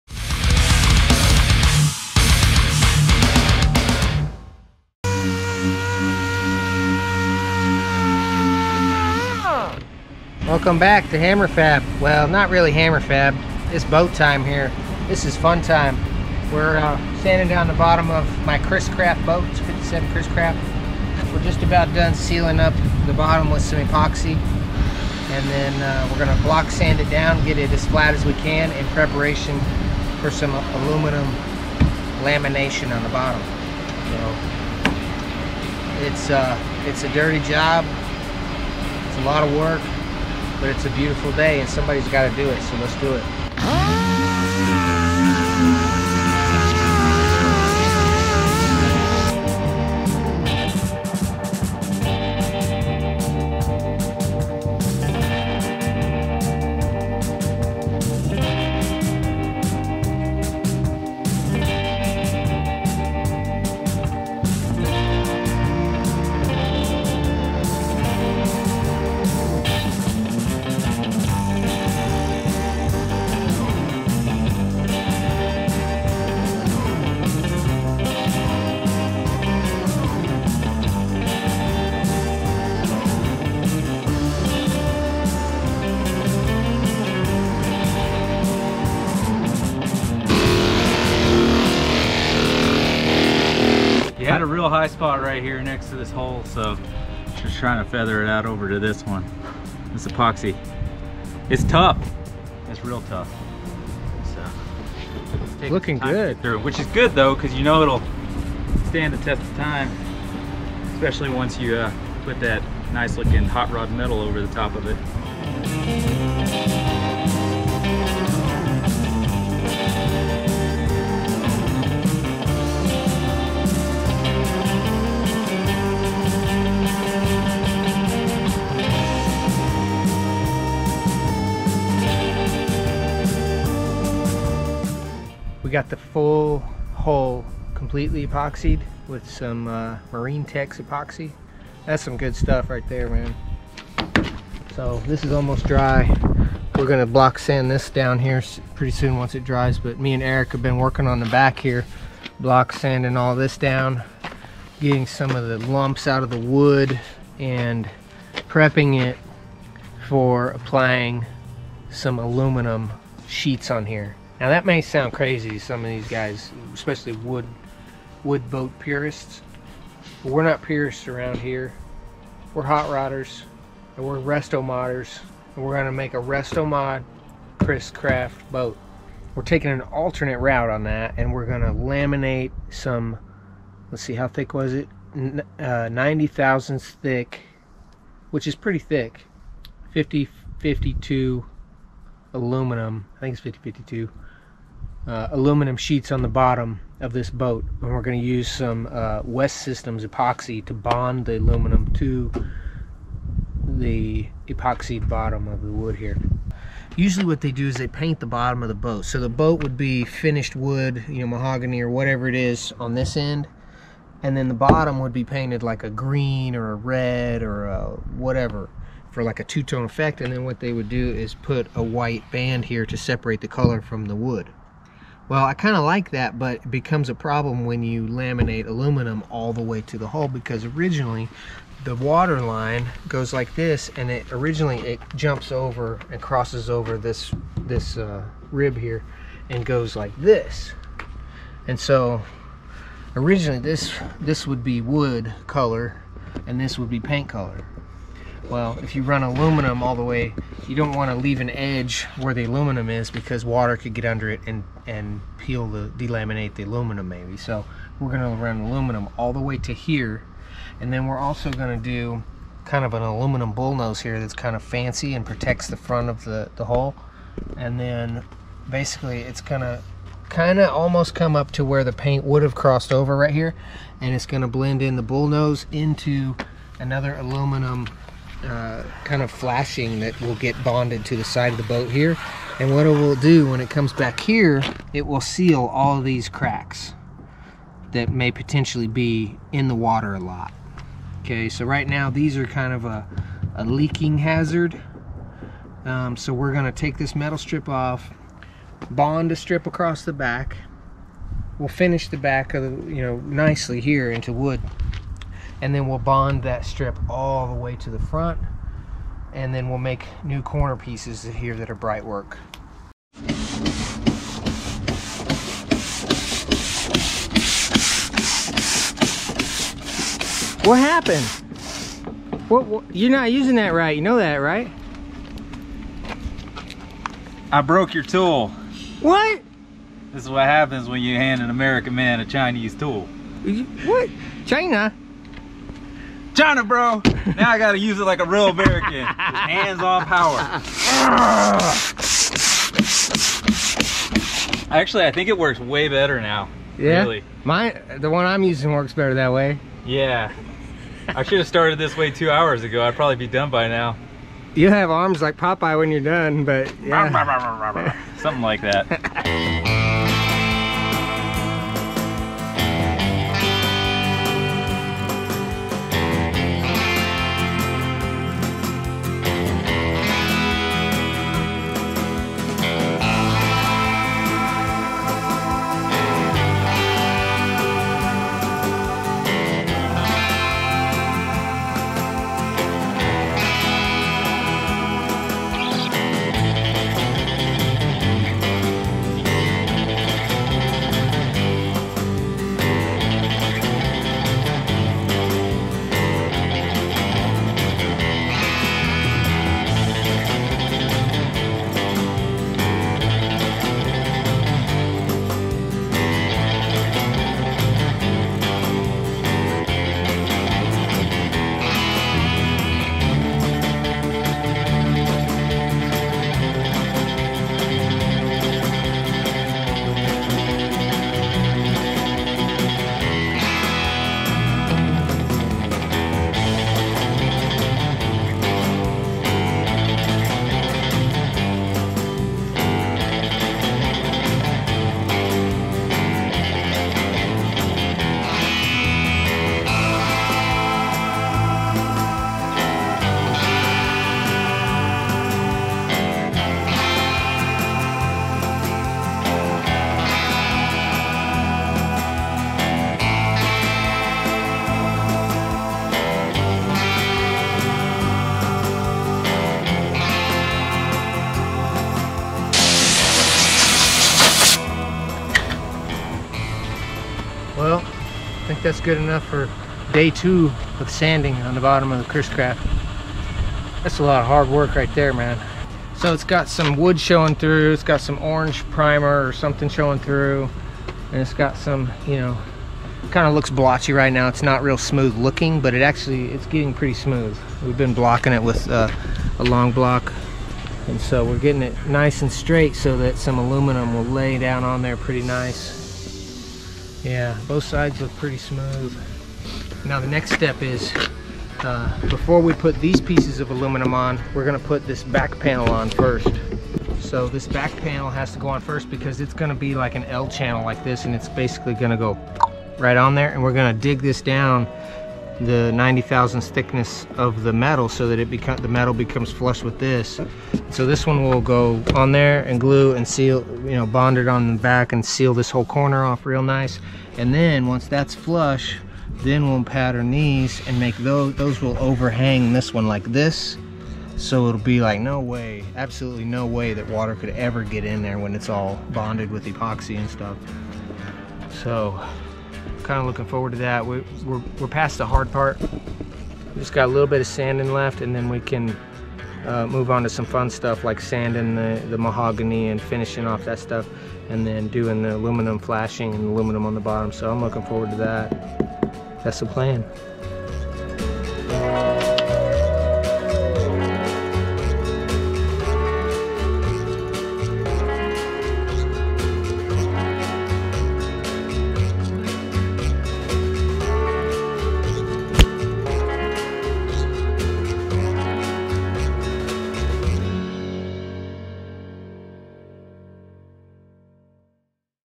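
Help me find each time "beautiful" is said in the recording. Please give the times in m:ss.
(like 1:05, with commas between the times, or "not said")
0:40.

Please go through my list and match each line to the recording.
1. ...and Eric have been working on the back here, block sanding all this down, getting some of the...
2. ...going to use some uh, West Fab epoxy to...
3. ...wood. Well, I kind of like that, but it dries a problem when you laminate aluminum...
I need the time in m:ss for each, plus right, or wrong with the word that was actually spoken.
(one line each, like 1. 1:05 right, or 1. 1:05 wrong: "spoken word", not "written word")
1. 2:30 right
2. 3:18 wrong: "Systems", not "Fab"
3. 3:44 wrong: "becomes", not "dries".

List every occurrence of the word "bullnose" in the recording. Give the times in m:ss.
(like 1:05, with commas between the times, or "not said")
4:23, 4:35.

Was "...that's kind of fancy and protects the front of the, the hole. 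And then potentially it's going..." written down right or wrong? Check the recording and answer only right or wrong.
wrong.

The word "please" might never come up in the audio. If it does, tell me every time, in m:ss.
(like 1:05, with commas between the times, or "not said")
not said.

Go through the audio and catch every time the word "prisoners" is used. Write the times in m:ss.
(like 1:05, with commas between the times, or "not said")
not said.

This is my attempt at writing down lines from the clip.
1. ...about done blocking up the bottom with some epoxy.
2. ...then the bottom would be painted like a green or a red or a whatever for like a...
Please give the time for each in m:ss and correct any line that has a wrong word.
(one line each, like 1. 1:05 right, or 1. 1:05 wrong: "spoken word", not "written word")
1. 0:21 wrong: "sealing", not "blocking"
2. 3:34 right.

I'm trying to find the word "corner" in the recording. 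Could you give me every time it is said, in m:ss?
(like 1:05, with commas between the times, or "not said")
5:10, 8:45.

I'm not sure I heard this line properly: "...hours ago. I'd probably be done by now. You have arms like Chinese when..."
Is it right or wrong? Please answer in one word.
wrong.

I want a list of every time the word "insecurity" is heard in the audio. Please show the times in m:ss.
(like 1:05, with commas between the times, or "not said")
not said.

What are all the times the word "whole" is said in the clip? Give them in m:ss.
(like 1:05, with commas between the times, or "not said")
8:45.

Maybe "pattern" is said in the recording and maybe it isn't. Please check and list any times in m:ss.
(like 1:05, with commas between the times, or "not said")
8:49.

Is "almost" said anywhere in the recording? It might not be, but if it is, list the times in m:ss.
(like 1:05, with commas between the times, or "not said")
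2:25, 4:30.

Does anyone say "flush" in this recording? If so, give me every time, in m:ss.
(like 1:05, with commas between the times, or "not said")
8:39, 8:48.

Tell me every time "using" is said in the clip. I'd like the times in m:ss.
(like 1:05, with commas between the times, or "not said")
5:23, 5:48.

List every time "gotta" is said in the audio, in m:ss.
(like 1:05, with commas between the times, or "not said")
5:37.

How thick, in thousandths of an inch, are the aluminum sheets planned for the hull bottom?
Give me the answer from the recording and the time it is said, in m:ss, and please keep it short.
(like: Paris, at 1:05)
90 thousandths, at 3:05.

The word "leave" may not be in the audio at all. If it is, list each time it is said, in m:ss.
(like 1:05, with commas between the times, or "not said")
4:11.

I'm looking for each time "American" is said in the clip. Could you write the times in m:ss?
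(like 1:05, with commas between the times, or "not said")
5:31, 5:38.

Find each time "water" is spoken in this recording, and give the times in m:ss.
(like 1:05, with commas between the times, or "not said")
3:51, 4:13, 4:49, 8:56.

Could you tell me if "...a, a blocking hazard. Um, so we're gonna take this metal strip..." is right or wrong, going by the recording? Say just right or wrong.
wrong.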